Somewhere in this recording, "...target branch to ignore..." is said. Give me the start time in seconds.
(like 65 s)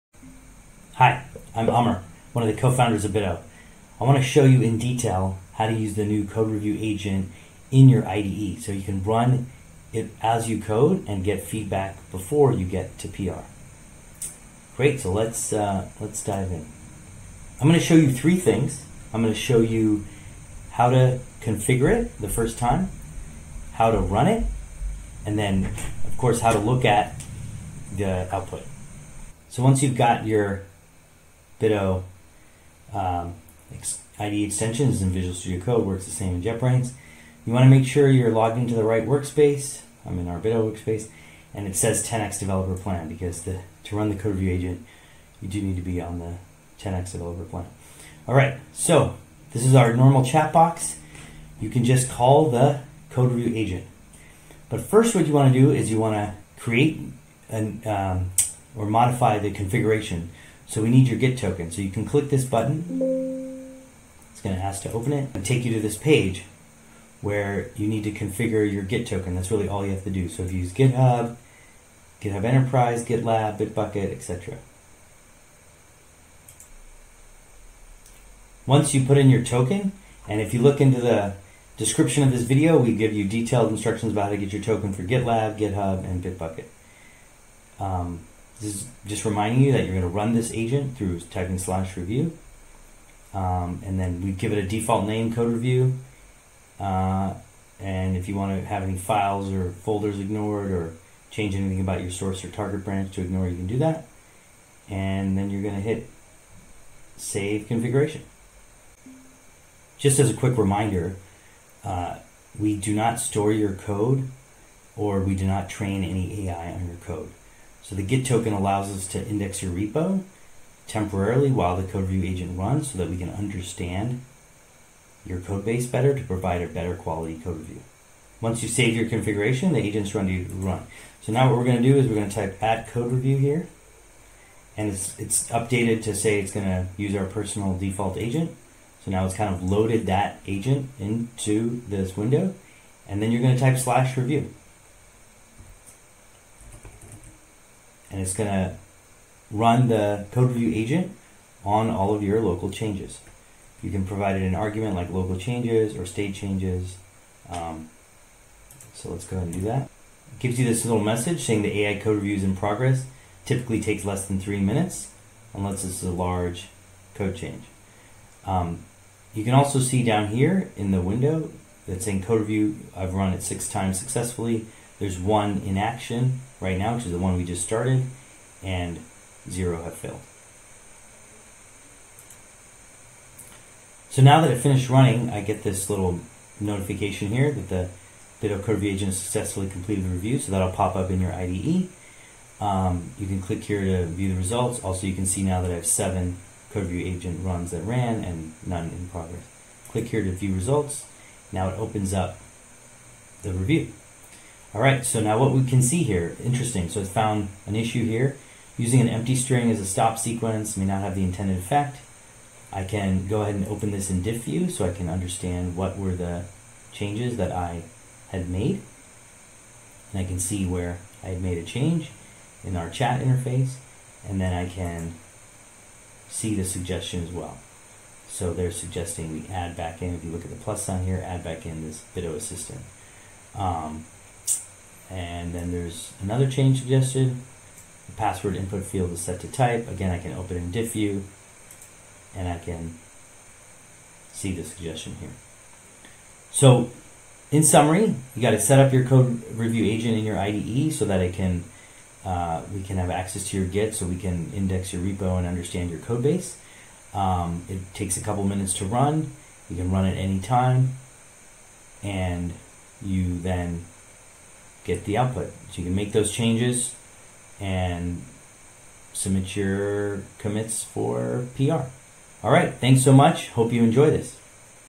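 102 s.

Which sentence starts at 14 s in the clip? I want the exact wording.
Great, so let's, uh, let's dive in.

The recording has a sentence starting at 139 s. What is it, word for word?
So now it's kind of loaded that agent into this window.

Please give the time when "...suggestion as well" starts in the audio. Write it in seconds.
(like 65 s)
226 s.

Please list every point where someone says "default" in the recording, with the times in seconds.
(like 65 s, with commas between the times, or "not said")
94 s, 137 s.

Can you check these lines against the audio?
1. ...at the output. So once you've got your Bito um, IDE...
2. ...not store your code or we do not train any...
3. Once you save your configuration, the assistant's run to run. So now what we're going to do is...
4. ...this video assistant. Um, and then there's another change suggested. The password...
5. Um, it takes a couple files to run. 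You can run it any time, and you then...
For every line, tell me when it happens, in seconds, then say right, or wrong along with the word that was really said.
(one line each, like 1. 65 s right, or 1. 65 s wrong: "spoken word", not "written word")
1. 26 s right
2. 112 s right
3. 128 s wrong: "agent", not "assistant"
4. 231 s right
5. 257 s wrong: "minutes", not "files".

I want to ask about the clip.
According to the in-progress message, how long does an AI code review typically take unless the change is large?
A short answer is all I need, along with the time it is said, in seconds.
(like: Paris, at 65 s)
less than 3 minutes, at 164 s.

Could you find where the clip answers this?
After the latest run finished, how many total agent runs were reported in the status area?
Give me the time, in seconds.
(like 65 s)
195 s.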